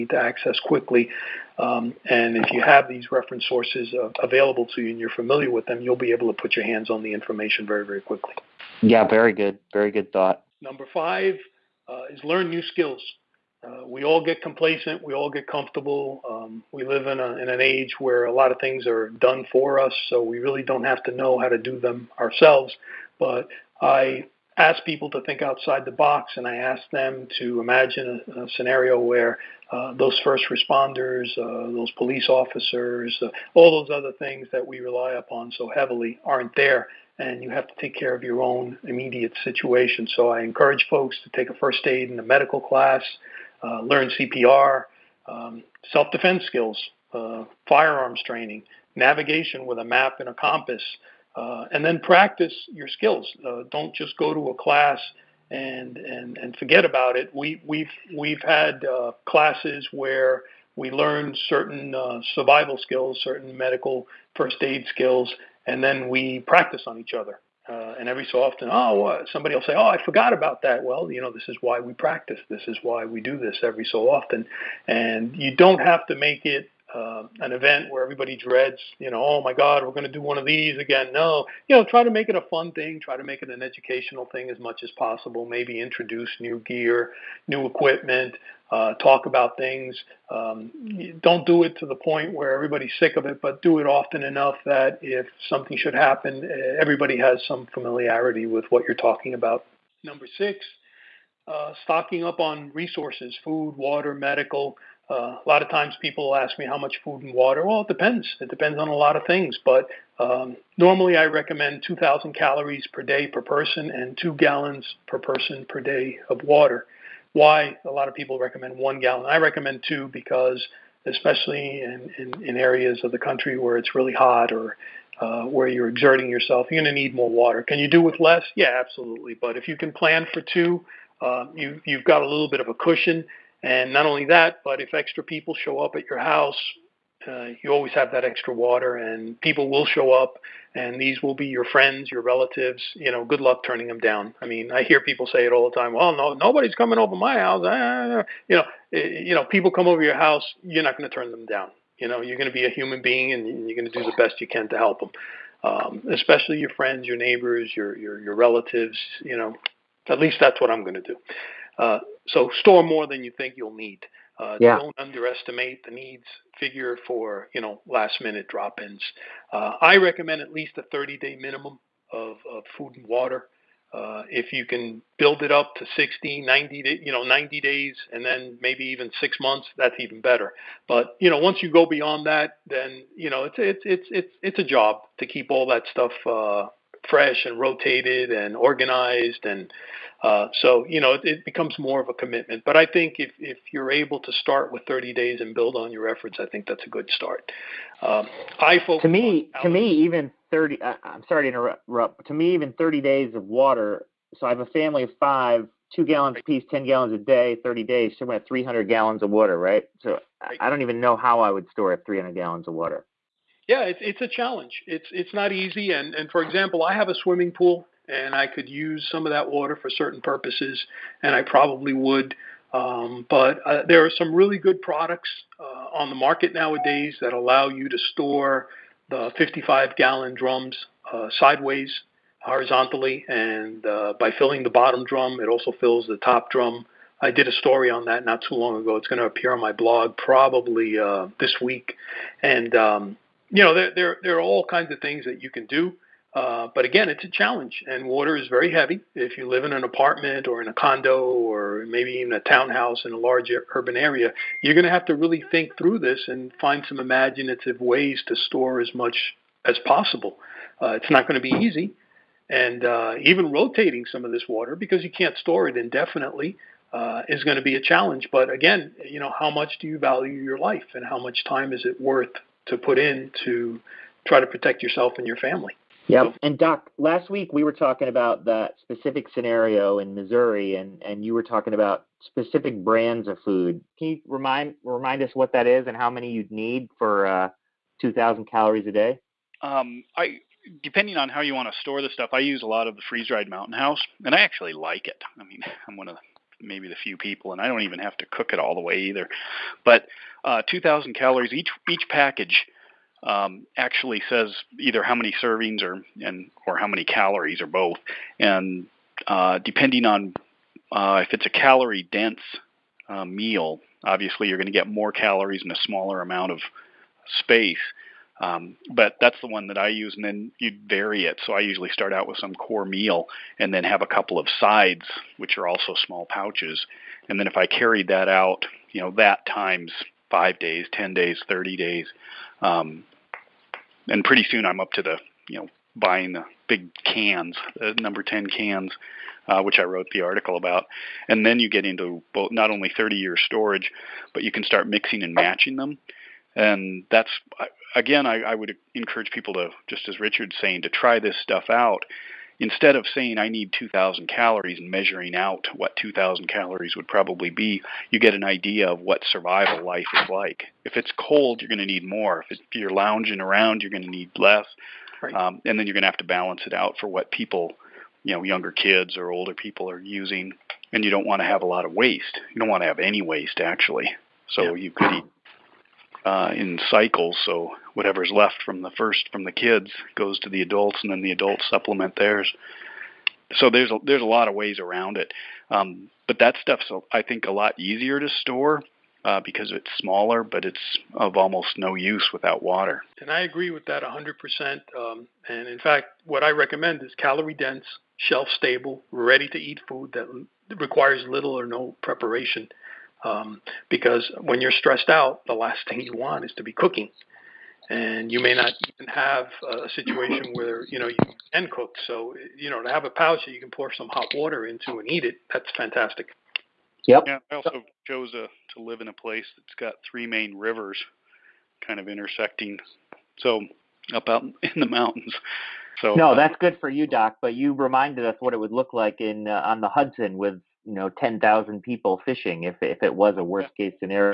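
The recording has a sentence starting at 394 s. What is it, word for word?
Um, and in fact, what I recommend is calorie dense, shelf stable, ready to eat food that requires little or no preparation.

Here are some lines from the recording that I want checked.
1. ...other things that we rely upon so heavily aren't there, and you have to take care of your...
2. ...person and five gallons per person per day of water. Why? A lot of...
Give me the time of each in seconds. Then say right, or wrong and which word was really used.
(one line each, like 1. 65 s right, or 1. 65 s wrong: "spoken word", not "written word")
1. 33 s right
2. 113 s wrong: "two", not "five".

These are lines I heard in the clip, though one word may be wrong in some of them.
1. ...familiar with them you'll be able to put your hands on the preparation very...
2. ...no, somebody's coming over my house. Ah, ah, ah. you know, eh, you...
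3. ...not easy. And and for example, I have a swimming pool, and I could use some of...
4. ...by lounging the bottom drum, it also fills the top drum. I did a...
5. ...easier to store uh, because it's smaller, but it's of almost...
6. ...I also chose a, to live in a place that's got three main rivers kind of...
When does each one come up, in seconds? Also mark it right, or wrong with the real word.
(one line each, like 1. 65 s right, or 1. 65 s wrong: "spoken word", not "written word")
1. 5 s wrong: "information", not "preparation"
2. 146 s wrong: "nobody", not "somebody"
3. 215 s right
4. 234 s wrong: "filling", not "lounging"
5. 387 s right
6. 417 s right.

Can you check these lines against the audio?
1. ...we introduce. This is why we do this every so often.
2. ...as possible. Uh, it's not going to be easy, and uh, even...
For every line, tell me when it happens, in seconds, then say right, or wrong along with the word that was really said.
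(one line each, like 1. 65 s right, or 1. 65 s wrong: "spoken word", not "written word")
1. 71 s wrong: "practice", not "introduce"
2. 259 s right.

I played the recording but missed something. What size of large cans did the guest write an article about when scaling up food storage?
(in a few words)
number 10.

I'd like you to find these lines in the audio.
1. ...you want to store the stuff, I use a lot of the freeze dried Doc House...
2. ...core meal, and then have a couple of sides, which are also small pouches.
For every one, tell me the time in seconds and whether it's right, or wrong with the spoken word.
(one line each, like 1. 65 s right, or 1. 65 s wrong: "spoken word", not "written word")
1. 291 s wrong: "Mountain", not "Doc"
2. 322 s right.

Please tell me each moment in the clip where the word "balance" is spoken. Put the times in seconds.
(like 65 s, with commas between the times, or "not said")
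366 s.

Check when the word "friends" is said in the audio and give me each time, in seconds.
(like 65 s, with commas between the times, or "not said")
141 s, 156 s.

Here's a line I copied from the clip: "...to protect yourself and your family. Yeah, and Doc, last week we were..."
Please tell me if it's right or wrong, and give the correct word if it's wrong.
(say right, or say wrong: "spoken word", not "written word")
right.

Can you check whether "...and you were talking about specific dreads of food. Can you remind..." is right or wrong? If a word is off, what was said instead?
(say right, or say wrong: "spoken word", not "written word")
wrong: "brands", not "dreads".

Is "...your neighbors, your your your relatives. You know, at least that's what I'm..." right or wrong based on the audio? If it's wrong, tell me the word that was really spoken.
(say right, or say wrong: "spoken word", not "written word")
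right.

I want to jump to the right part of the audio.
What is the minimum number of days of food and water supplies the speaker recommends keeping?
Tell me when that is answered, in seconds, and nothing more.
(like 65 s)
170 s.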